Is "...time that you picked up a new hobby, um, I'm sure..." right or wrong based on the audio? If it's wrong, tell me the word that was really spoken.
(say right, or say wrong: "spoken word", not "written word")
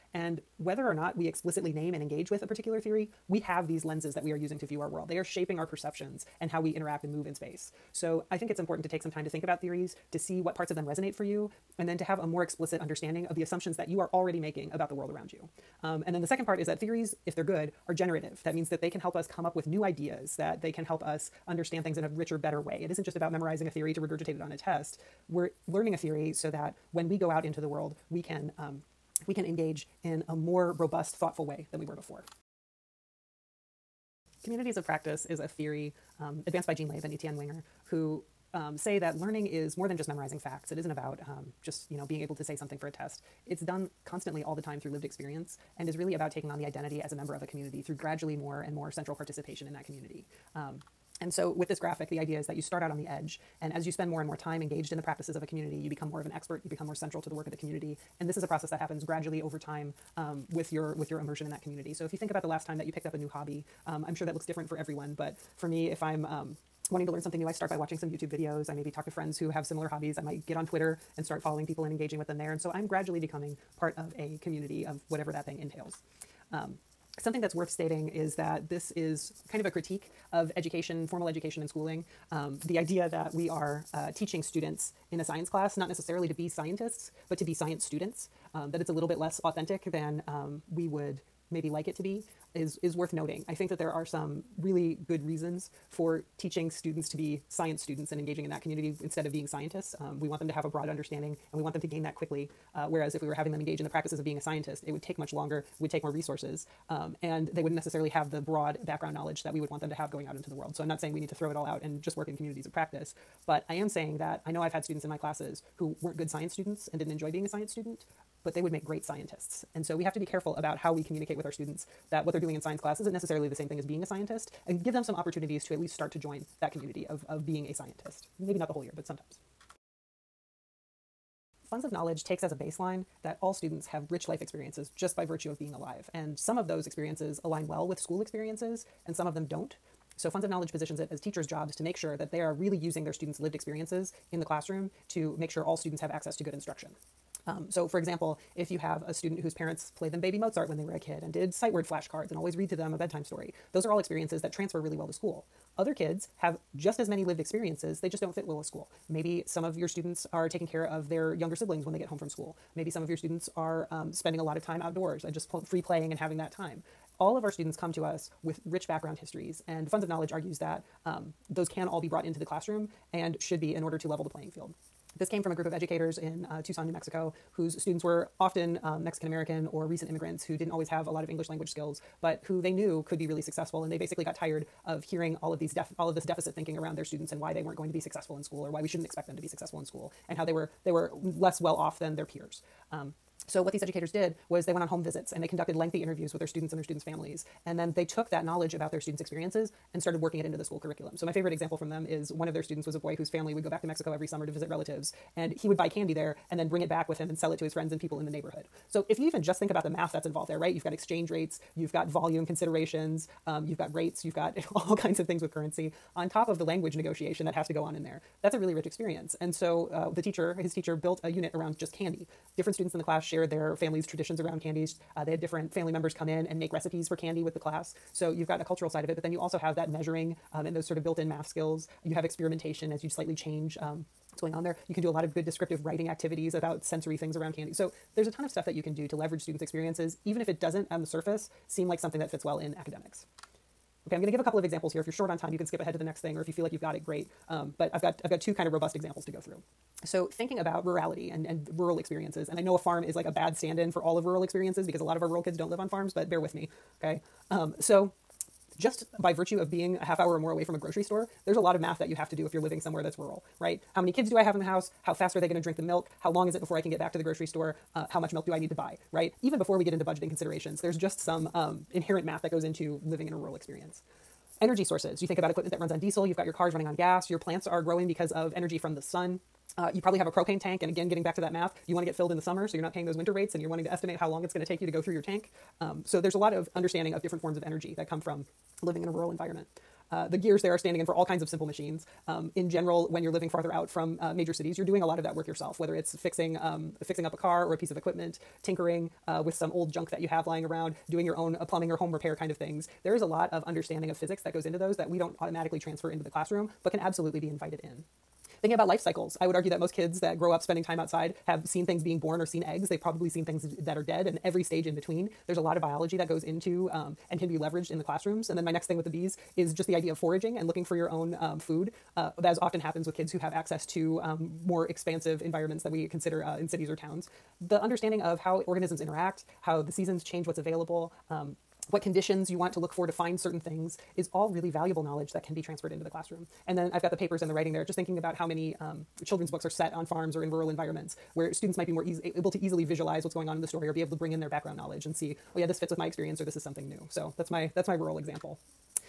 right.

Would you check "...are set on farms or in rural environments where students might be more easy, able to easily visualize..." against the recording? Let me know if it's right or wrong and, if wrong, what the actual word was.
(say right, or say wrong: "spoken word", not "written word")
right.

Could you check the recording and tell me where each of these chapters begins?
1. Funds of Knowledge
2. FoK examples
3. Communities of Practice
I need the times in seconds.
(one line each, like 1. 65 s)
1. 129 s
2. 243 s
3. 32 s.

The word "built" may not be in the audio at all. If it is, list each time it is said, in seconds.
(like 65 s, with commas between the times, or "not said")
220 s, 231 s.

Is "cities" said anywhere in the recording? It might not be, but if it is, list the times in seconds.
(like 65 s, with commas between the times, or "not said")
294 s, 326 s.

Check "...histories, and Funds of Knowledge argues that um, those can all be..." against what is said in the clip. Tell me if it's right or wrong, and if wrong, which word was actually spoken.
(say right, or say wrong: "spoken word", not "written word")
right.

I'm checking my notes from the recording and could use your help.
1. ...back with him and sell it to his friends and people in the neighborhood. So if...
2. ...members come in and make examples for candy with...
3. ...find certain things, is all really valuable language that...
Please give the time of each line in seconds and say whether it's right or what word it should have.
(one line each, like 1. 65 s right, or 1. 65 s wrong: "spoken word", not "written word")
1. 206 s right
2. 225 s wrong: "recipes", not "examples"
3. 333 s wrong: "knowledge", not "language".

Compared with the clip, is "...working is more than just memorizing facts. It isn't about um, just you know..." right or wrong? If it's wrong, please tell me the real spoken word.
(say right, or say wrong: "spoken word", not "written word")
wrong: "learning", not "working".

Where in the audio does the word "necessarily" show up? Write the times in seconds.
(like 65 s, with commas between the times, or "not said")
85 s, 107 s, 123 s.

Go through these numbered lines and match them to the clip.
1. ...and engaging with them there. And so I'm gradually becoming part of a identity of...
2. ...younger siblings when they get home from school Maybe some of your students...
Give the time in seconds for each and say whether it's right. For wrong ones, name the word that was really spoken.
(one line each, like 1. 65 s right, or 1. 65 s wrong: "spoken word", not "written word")
1. 71 s wrong: "community", not "identity"
2. 161 s right.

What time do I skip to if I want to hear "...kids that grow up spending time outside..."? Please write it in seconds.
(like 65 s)
309 s.